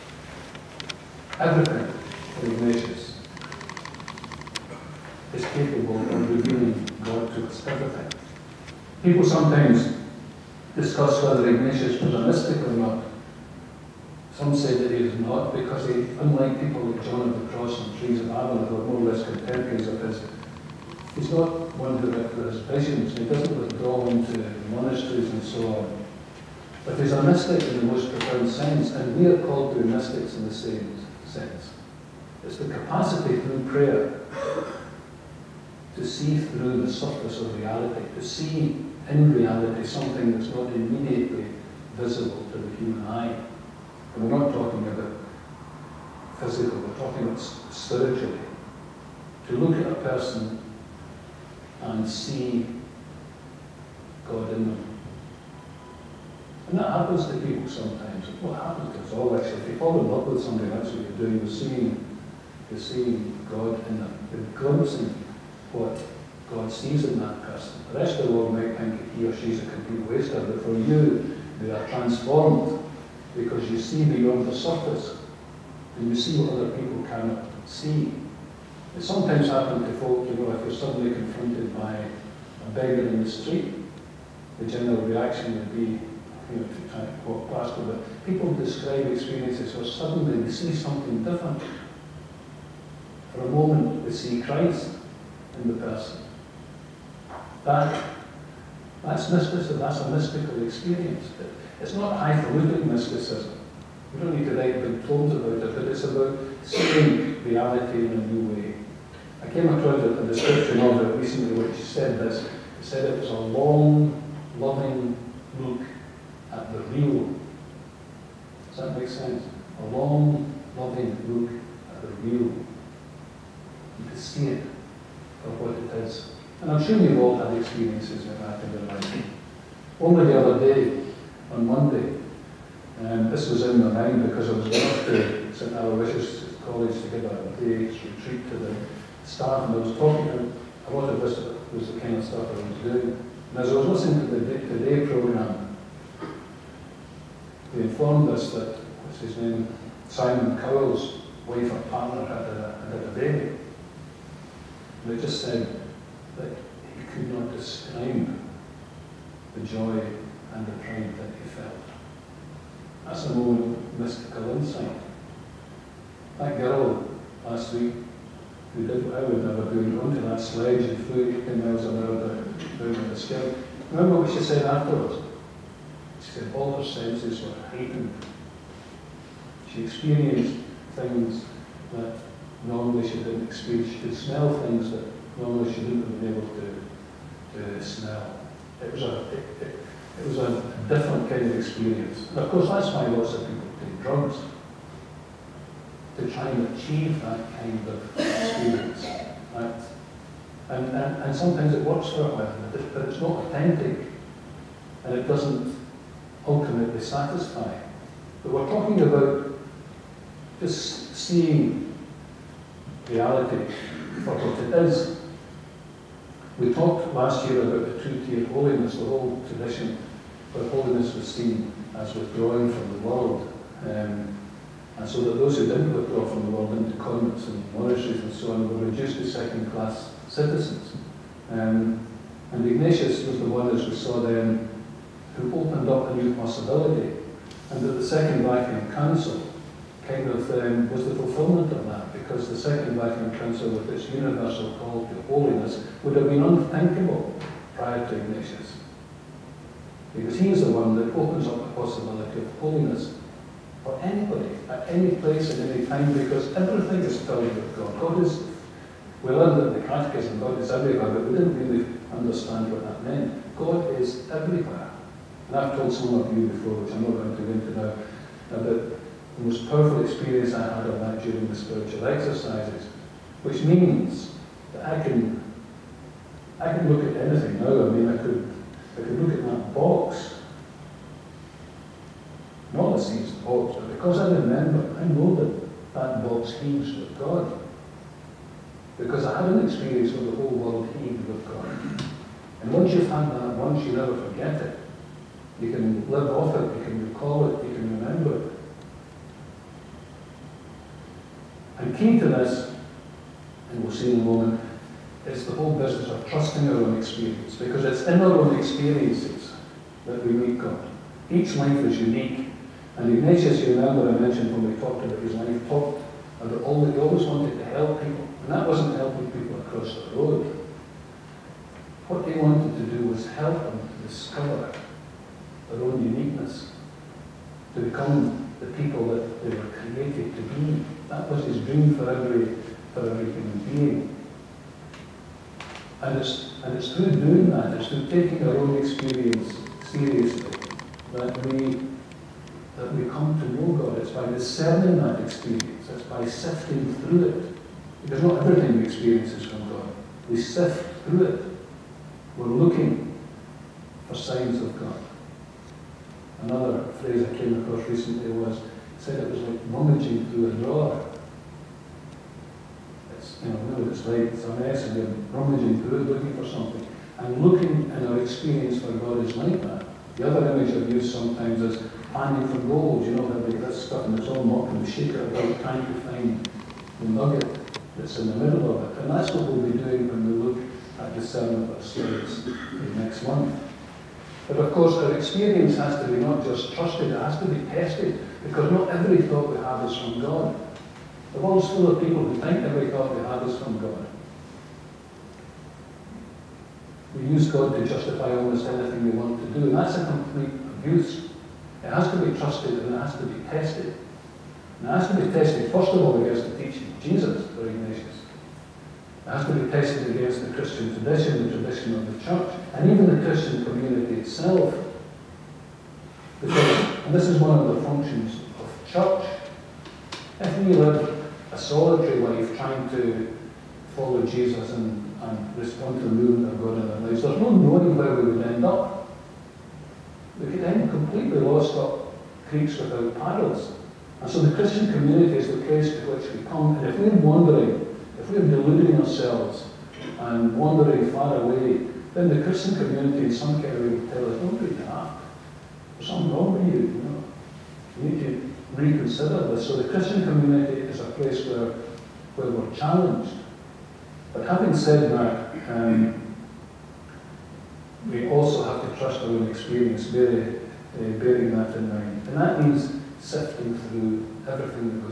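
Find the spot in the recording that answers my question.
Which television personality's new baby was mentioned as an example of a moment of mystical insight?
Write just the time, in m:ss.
2:30.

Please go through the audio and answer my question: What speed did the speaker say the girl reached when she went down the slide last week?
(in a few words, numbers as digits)
18 miles an hour.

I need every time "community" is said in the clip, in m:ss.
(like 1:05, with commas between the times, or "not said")
6:53, 7:14, 7:22, 7:30.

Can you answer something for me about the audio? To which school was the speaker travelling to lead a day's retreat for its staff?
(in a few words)
St. Aloysius College.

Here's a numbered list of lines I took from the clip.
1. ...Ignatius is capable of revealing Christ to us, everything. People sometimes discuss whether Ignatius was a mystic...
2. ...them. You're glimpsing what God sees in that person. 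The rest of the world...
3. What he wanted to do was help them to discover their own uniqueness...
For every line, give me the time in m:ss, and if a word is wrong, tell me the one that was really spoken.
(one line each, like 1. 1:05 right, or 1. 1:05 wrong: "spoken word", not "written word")
1. 0:02 wrong: "God", not "Christ"
2. 1:03 right
3. 5:22 right.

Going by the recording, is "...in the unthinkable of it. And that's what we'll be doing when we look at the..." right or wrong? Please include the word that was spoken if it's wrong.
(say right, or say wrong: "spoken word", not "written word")
wrong: "middle", not "unthinkable".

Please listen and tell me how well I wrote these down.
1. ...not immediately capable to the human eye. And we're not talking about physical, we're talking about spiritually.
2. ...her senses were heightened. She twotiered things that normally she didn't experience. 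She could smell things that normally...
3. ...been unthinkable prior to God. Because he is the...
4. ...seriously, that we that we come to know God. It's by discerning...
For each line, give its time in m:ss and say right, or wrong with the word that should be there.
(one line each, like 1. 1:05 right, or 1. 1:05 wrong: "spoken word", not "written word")
1. 0:40 wrong: "visible", not "capable"
2. 2:56 wrong: "experienced", not "twotiered"
3. 4:06 wrong: "Ignatius", not "God"
4. 5:39 right.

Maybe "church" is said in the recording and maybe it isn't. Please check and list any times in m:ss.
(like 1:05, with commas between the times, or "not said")
6:52, 6:58.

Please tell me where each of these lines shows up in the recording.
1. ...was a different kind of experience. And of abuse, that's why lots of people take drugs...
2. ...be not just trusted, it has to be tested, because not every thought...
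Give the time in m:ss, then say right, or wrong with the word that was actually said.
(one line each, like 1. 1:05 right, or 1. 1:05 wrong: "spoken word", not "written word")
1. 3:10 wrong: "course", not "abuse"
2. 6:26 right.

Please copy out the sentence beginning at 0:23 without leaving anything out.
He doesn't withdraw into monasteries and so on.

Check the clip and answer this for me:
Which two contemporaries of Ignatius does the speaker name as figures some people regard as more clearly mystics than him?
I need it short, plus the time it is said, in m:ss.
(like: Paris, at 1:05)
John of the Cross and Teresa of Avila, at 0:17.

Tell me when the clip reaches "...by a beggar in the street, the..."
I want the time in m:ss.
1:21.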